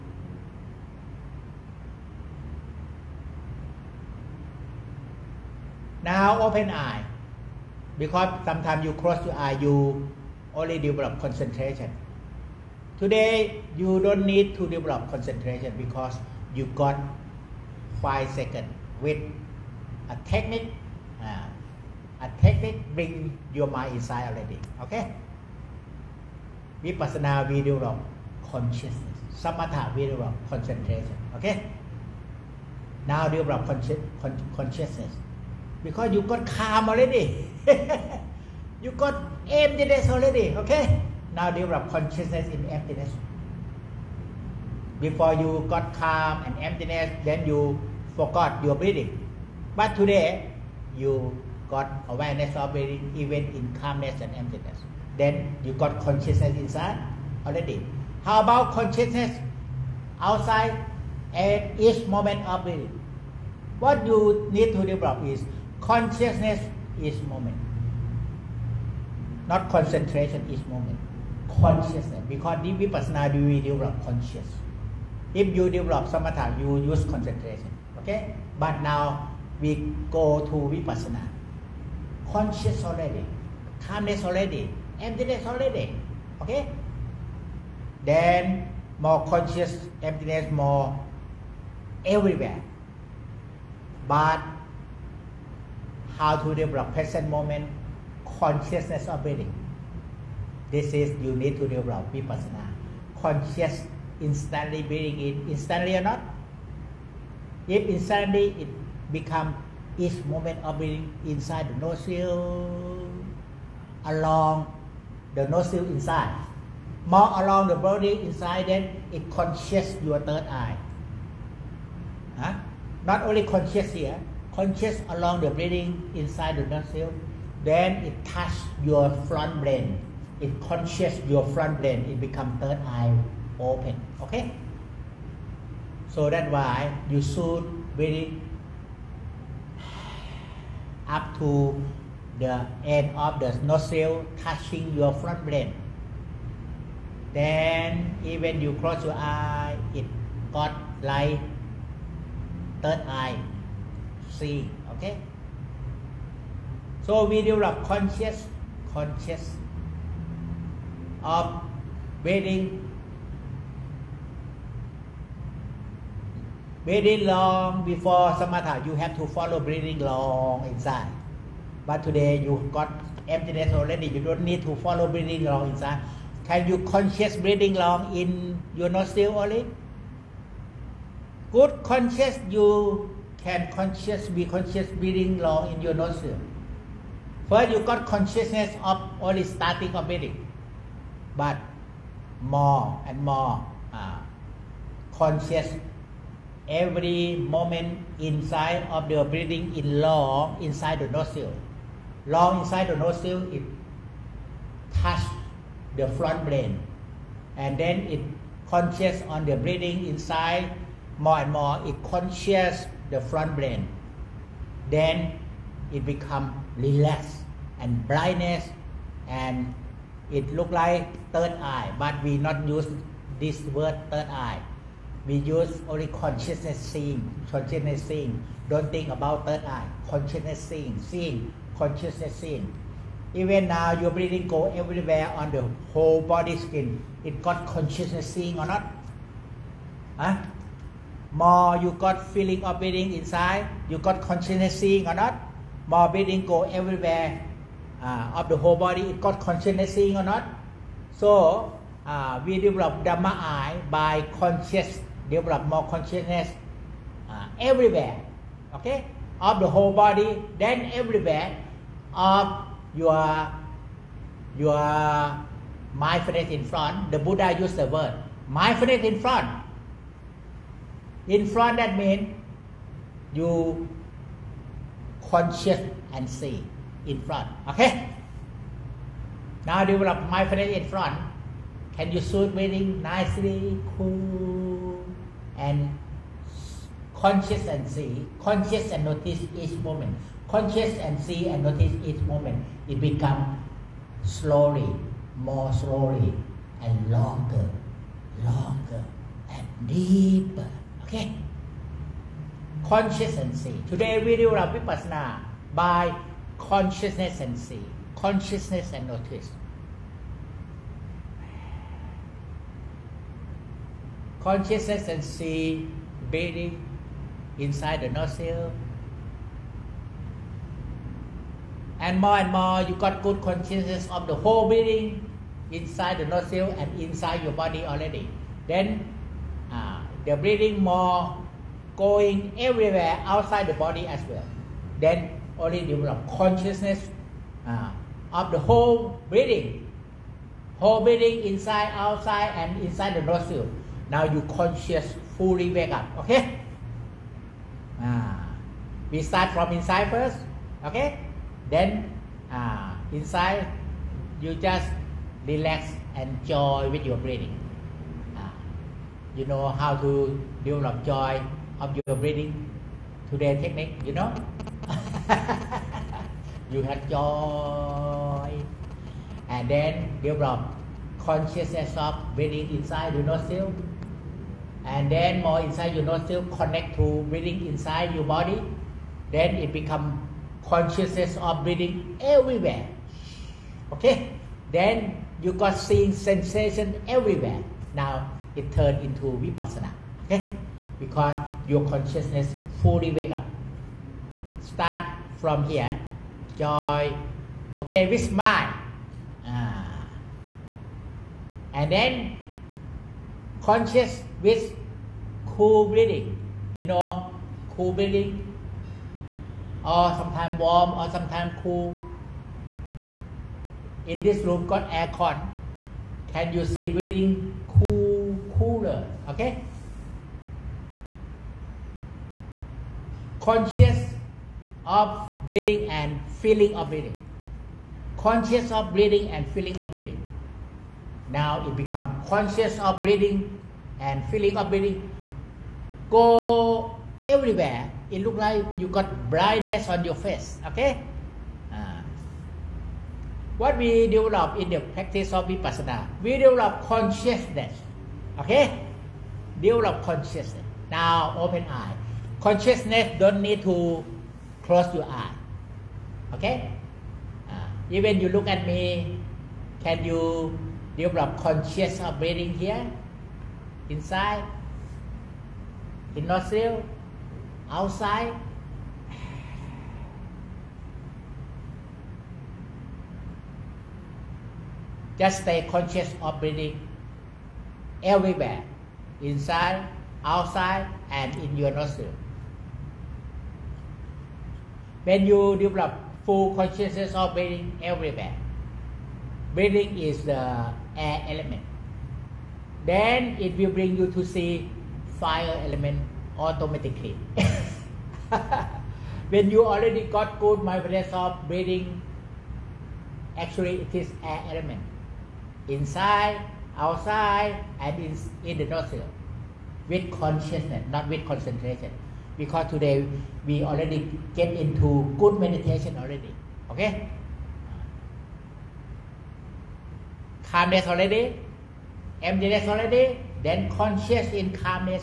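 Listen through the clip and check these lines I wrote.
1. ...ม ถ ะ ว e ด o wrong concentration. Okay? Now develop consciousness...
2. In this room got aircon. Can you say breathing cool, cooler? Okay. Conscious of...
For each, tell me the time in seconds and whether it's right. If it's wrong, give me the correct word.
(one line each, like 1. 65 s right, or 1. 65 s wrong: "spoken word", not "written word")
1. 29 s right
2. 414 s right.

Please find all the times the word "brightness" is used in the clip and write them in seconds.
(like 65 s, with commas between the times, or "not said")
218 s, 439 s.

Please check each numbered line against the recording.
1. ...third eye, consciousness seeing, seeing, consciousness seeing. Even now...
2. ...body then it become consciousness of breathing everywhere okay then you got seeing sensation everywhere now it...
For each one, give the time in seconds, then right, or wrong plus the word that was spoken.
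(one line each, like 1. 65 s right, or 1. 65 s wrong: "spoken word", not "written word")
1. 229 s right
2. 378 s right.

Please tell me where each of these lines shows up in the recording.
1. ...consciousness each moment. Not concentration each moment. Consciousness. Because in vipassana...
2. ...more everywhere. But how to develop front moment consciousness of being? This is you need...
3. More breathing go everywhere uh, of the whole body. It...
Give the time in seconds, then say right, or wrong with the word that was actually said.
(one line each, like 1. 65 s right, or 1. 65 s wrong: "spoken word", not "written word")
1. 65 s right
2. 90 s wrong: "present", not "front"
3. 245 s right.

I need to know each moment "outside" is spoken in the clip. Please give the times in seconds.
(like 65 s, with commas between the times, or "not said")
60 s, 333 s, 341 s, 467 s, 480 s, 506 s.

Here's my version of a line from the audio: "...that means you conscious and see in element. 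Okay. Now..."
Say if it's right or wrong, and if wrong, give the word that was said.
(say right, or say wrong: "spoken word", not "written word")
wrong: "front", not "element".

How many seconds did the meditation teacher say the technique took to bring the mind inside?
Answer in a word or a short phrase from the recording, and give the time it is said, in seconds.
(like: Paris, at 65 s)
5, at 18 s.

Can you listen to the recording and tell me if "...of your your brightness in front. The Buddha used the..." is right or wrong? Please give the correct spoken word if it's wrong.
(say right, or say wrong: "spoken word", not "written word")
wrong: "mindfulness", not "brightness".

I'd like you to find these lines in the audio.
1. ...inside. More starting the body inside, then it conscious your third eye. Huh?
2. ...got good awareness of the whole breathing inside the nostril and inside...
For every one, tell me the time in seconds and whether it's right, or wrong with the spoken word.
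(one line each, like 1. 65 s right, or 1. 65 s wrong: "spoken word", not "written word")
1. 115 s wrong: "along", not "starting"
2. 322 s wrong: "consciousness", not "awareness".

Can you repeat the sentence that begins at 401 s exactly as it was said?
and then conscious with cool breathing.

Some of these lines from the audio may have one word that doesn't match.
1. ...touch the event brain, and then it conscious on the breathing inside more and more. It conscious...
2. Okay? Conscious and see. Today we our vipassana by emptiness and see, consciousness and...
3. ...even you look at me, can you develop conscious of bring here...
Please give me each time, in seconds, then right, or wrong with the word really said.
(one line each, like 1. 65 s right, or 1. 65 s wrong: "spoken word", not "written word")
1. 204 s wrong: "front", not "event"
2. 301 s wrong: "consciousness", not "emptiness"
3. 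457 s wrong: "breathing", not "bring".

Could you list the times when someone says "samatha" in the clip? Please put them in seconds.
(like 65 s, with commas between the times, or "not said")
76 s, 168 s.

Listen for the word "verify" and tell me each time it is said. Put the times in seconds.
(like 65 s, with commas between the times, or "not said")
not said.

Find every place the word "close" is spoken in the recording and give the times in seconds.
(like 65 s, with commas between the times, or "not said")
8 s, 148 s, 454 s.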